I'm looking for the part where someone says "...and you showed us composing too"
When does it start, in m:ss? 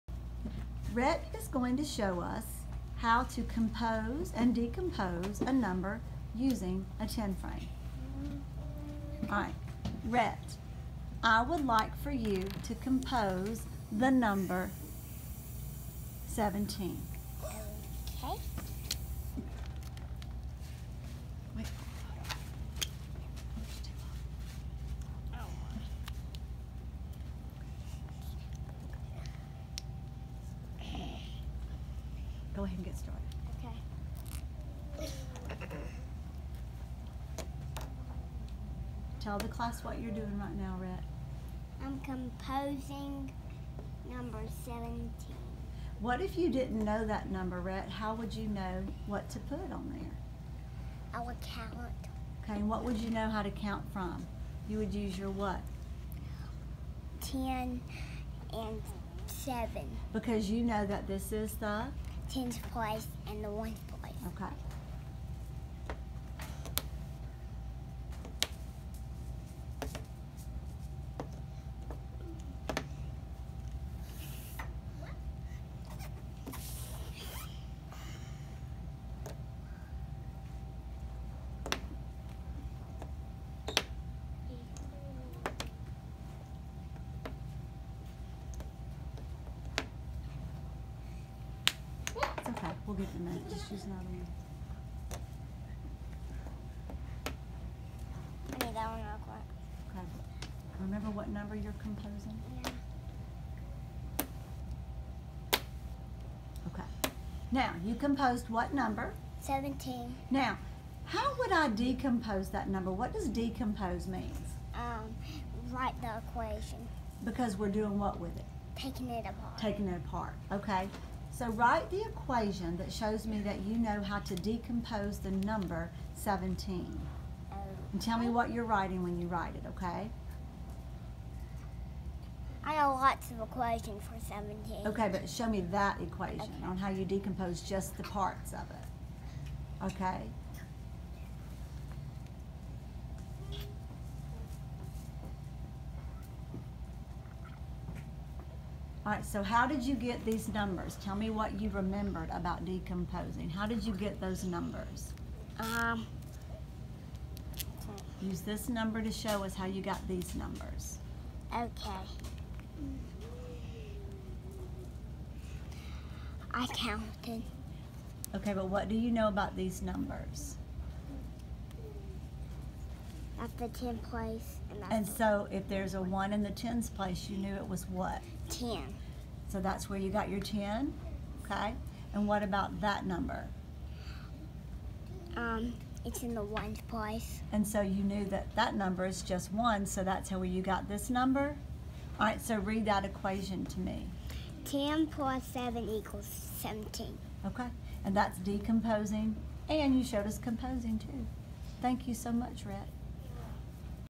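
3:19.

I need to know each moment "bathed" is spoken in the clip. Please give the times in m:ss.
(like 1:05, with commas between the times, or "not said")
not said.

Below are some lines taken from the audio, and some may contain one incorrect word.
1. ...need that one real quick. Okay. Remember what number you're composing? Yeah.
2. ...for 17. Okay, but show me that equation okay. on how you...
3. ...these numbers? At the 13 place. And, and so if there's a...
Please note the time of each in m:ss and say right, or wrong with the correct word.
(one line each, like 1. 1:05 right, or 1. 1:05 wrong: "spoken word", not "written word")
1. 1:38 right
2. 2:14 right
3. 2:49 wrong: "10", not "13".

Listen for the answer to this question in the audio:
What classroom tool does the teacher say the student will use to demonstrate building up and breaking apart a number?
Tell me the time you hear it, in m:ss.
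0:07.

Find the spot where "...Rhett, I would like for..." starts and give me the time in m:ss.
0:10.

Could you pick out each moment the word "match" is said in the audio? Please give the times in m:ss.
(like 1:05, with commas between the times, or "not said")
1:33.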